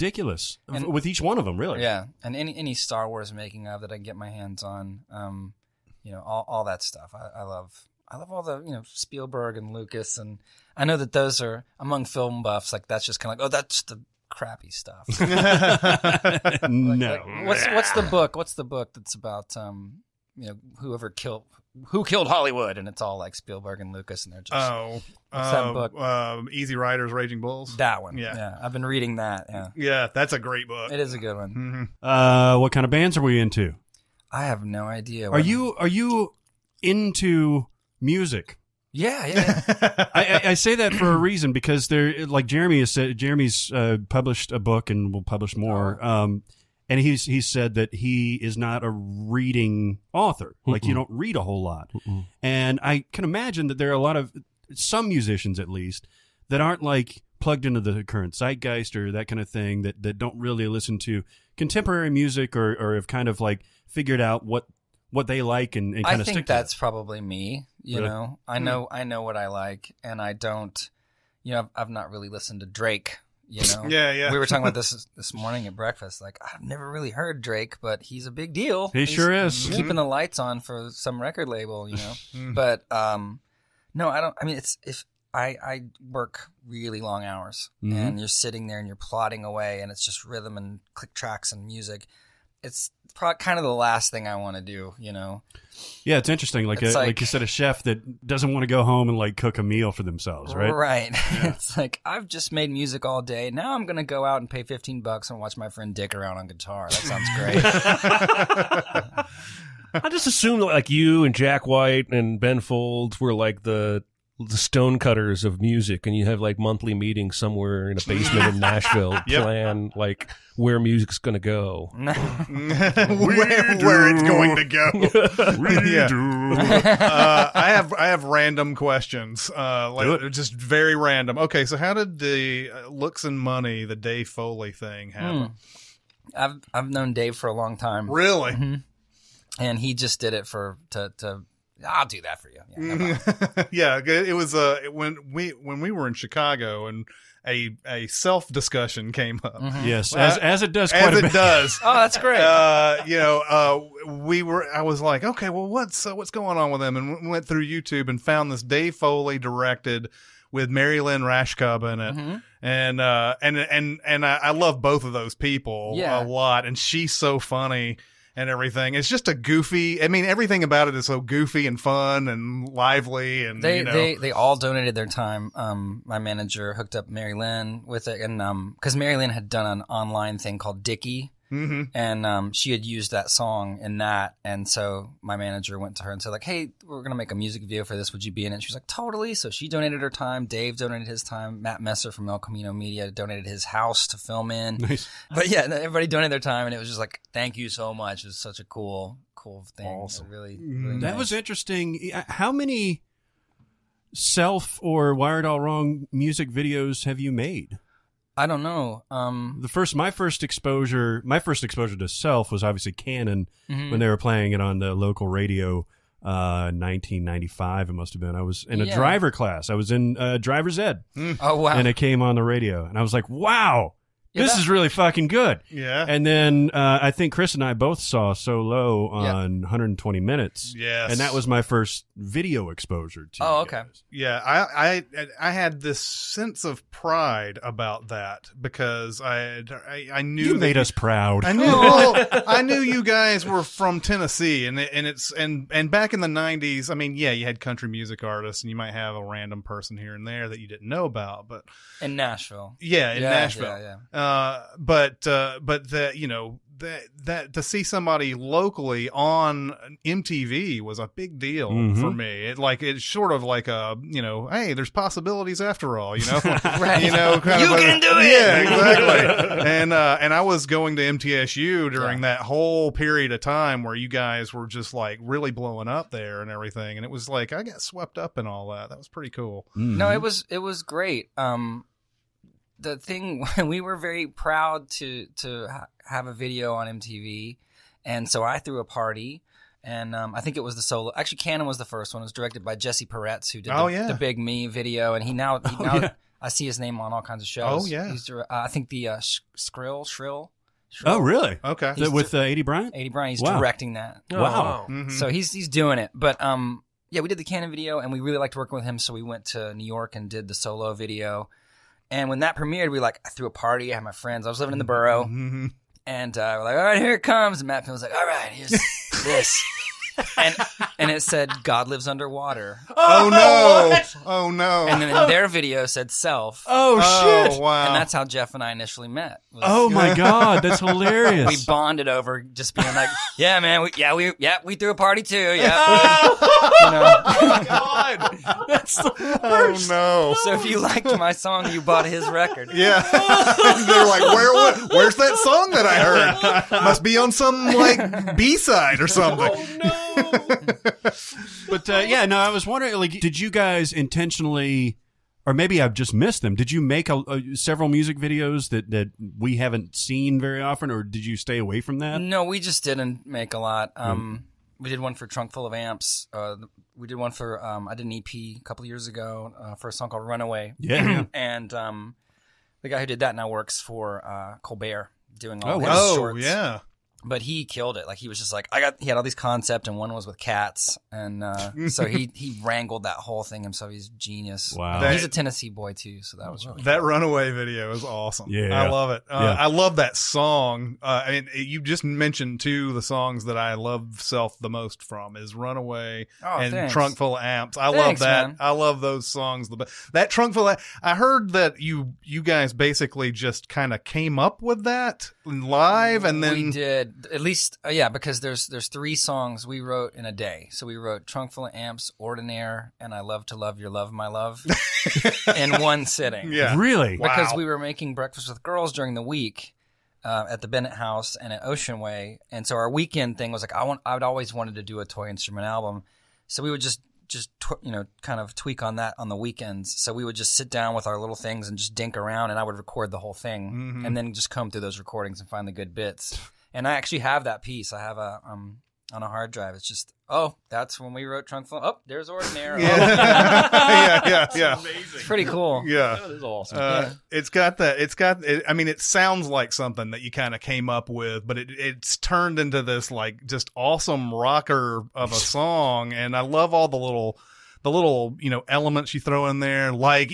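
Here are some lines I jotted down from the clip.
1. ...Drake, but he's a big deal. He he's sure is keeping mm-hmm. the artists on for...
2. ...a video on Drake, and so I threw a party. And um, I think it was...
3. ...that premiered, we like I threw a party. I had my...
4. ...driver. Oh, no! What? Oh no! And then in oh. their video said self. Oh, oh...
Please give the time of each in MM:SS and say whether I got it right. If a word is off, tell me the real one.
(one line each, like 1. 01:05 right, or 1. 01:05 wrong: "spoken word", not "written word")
1. 01:17 wrong: "lights", not "artists"
2. 04:46 wrong: "MTV", not "Drake"
3. 05:12 right
4. 05:22 wrong: "underwater", not "driver".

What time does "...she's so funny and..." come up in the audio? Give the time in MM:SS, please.
02:46.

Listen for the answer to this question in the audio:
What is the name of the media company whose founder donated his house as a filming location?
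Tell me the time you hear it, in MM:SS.
03:12.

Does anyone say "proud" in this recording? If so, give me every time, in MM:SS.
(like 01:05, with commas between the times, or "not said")
04:00, 04:44.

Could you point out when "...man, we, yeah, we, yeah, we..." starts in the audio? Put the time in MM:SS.
05:33.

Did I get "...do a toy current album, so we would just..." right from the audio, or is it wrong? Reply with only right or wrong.
wrong.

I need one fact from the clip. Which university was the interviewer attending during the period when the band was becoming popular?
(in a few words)
MTSU.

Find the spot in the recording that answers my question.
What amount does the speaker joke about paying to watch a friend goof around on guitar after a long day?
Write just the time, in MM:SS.
01:44.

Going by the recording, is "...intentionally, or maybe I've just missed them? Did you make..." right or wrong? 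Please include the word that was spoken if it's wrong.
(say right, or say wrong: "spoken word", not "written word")
right.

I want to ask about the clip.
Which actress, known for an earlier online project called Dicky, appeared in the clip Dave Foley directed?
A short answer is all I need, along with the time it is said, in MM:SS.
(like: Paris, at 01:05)
Mary Lynn Rajskub, at 02:40.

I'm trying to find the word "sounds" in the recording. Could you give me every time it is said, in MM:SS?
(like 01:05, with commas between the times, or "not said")
01:48, 07:29.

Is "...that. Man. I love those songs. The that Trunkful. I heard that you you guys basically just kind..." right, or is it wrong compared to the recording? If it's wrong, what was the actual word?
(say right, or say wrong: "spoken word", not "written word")
right.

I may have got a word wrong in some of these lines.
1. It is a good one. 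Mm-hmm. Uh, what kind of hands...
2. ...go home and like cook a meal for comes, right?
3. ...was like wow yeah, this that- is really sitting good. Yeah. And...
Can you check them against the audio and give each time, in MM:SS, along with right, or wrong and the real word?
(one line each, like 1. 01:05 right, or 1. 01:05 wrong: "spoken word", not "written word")
1. 00:30 wrong: "bands", not "hands"
2. 01:38 wrong: "themselves", not "comes"
3. 03:43 wrong: "fucking", not "sitting".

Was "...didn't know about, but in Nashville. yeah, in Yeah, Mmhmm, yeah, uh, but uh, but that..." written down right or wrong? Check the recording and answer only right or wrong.
wrong.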